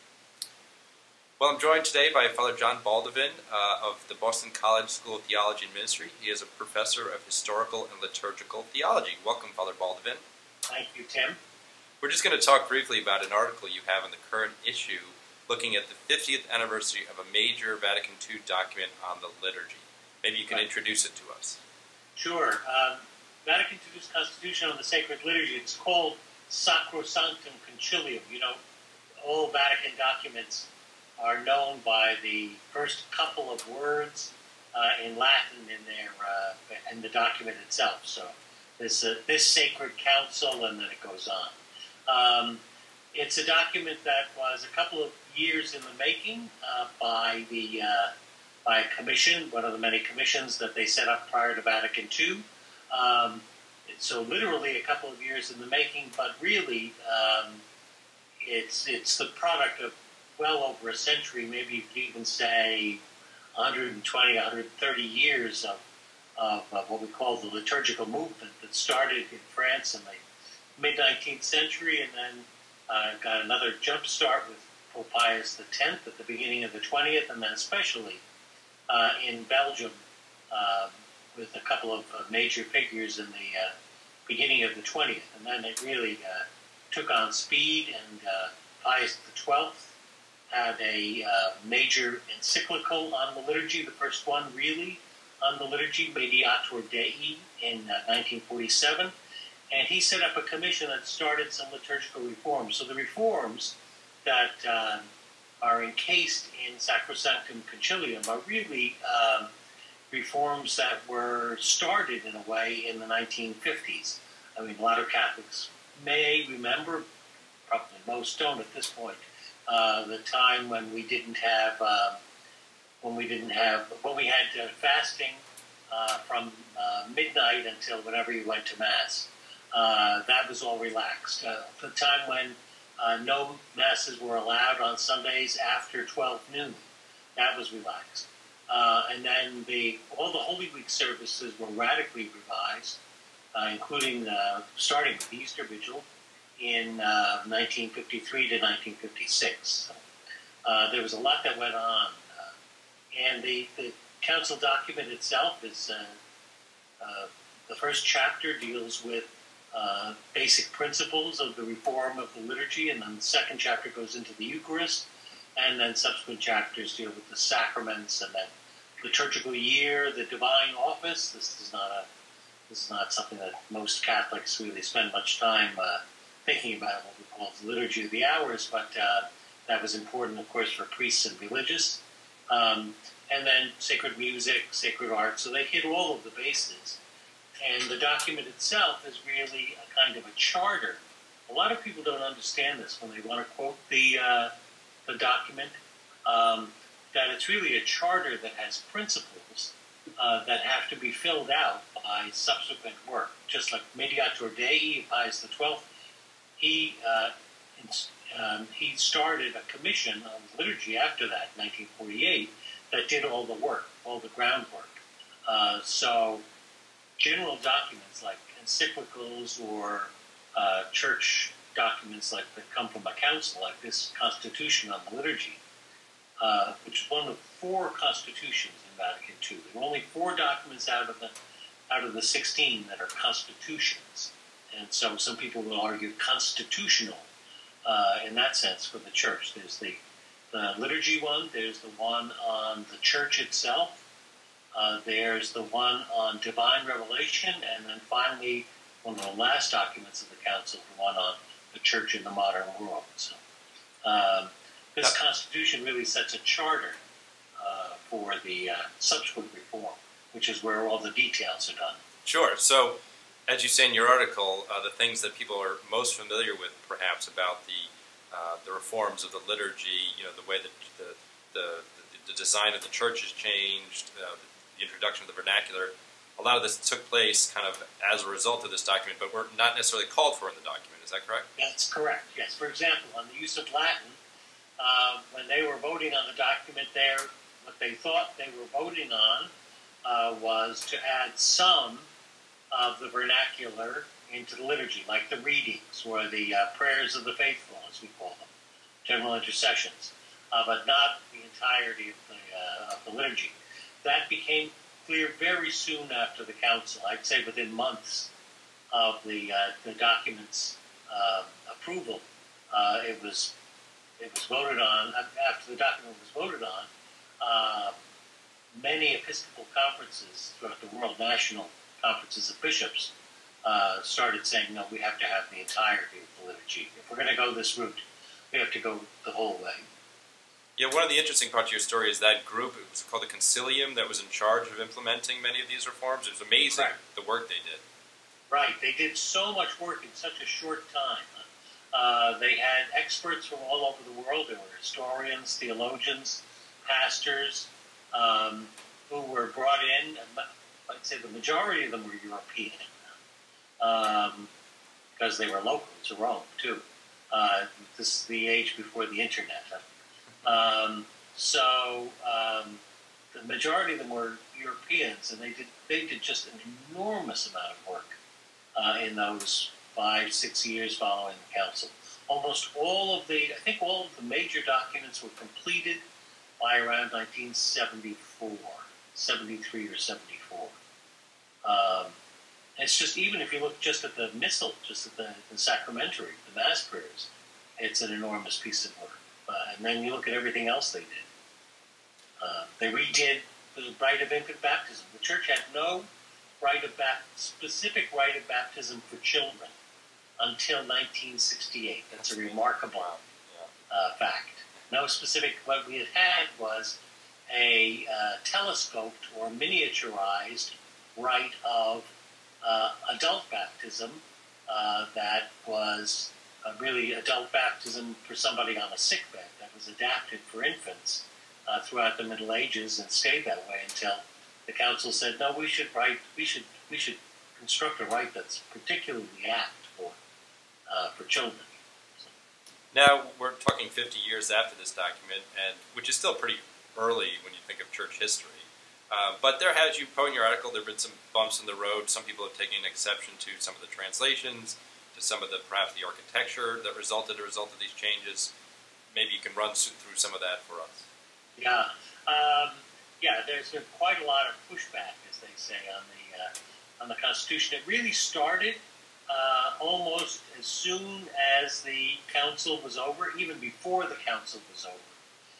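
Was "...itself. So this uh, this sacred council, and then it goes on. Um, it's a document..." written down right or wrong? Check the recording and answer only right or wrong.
right.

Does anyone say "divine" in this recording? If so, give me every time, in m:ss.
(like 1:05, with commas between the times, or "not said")
2:50, 4:06.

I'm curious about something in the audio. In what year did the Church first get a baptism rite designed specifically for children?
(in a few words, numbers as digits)
1968.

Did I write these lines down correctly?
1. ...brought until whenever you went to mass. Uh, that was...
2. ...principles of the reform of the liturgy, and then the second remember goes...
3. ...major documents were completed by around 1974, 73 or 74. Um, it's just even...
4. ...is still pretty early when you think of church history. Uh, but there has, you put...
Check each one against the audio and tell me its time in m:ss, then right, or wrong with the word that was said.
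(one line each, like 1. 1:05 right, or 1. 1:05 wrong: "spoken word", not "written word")
1. 2:07 wrong: "midnight", not "brought"
2. 2:40 wrong: "chapter", not "remember"
3. 6:14 right
4. 7:16 right.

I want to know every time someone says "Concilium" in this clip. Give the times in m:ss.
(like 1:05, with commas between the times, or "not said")
0:27, 1:47, 5:33.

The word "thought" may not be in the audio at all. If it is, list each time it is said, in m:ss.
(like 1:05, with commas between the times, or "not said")
4:47.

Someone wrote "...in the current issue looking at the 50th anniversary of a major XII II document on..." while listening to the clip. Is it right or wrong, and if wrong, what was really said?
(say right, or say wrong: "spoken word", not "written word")
wrong: "Vatican", not "XII".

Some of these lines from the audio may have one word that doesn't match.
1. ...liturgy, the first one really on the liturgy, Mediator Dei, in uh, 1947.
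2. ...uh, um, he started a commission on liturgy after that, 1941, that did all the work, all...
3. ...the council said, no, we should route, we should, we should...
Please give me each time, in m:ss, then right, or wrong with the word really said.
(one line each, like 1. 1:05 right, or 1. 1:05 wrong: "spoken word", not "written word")
1. 1:33 right
2. 3:27 wrong: "1948", not "1941"
3. 7:04 wrong: "write", not "route".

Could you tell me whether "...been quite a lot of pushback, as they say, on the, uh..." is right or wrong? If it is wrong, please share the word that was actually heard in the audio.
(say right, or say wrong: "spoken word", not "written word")
right.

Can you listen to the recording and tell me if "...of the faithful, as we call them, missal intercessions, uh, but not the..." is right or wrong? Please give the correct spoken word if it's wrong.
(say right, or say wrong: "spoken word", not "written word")
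wrong: "general", not "missal".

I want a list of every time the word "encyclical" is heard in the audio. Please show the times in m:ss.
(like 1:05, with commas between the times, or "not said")
1:32, 3:38.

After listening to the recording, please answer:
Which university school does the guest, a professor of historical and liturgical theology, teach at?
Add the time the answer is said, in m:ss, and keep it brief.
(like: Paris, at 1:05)
Boston College School of Theology and Ministry, at 0:04.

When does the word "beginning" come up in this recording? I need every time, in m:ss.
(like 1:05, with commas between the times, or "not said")
1:16, 1:24.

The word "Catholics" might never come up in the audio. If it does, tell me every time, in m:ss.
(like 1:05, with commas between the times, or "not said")
1:55, 2:54.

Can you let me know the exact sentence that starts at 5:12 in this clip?
Uh, it was it was voted on after the document was voted on.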